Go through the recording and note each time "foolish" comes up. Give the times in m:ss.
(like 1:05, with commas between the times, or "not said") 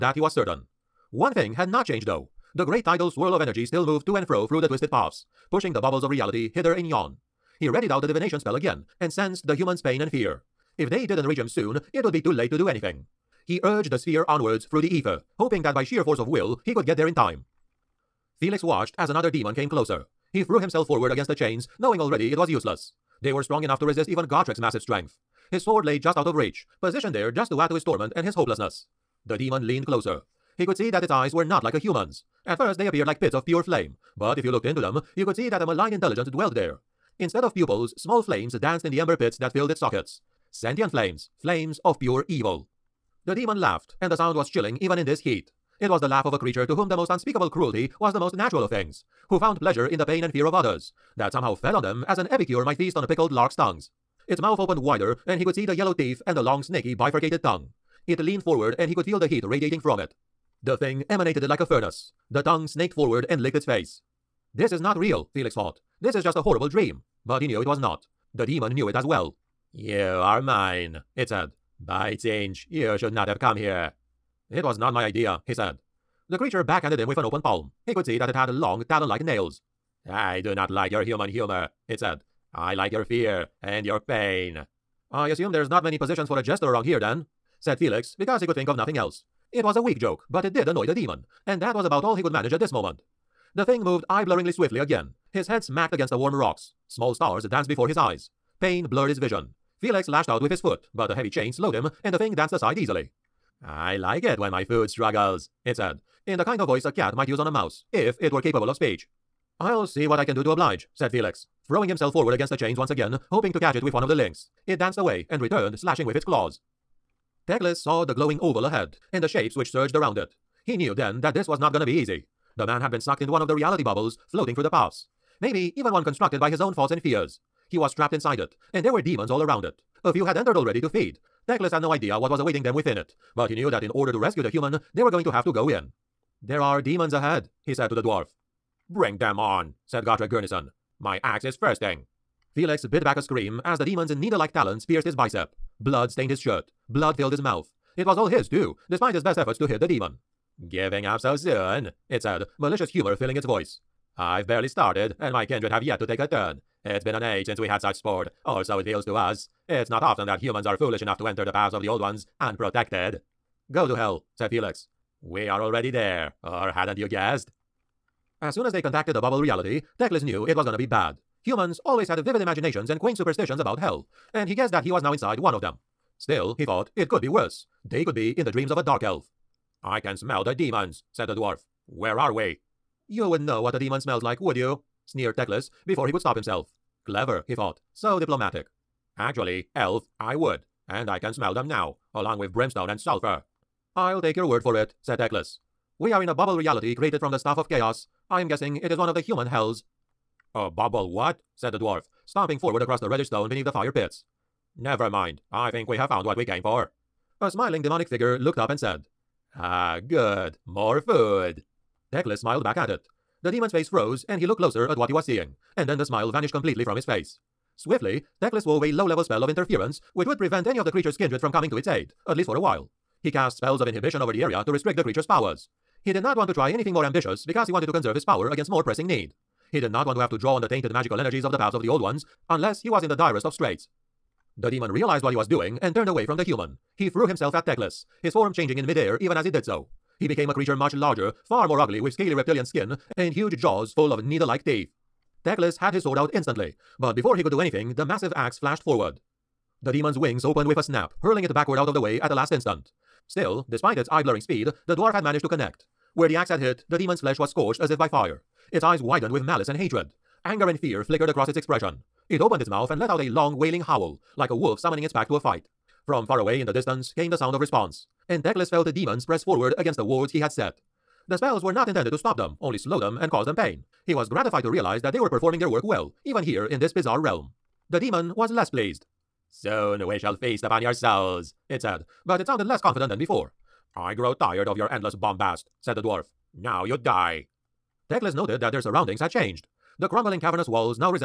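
2:40.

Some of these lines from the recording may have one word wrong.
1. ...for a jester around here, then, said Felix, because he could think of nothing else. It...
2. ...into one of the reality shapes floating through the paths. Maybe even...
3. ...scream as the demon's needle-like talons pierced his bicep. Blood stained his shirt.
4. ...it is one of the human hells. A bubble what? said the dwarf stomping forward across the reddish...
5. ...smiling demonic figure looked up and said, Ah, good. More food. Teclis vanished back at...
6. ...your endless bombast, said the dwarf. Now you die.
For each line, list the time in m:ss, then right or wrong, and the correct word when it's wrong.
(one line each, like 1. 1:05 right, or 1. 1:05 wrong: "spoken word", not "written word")
1. 1:26 right
2. 2:03 wrong: "bubbles", not "shapes"
3. 2:23 right
4. 3:18 right
5. 3:27 wrong: "smiled", not "vanished"
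6. 4:44 right.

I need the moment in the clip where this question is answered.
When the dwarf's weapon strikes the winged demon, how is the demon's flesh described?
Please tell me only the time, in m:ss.
4:17.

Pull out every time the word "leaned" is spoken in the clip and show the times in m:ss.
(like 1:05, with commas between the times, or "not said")
0:29, 0:58.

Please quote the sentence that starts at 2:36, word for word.
It's been an age since we had such sport, or so it feels to us.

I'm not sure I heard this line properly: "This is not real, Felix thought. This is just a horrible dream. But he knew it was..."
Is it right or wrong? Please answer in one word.
right.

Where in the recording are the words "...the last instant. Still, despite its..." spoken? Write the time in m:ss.
4:12.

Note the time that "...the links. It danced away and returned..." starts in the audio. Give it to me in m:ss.
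1:54.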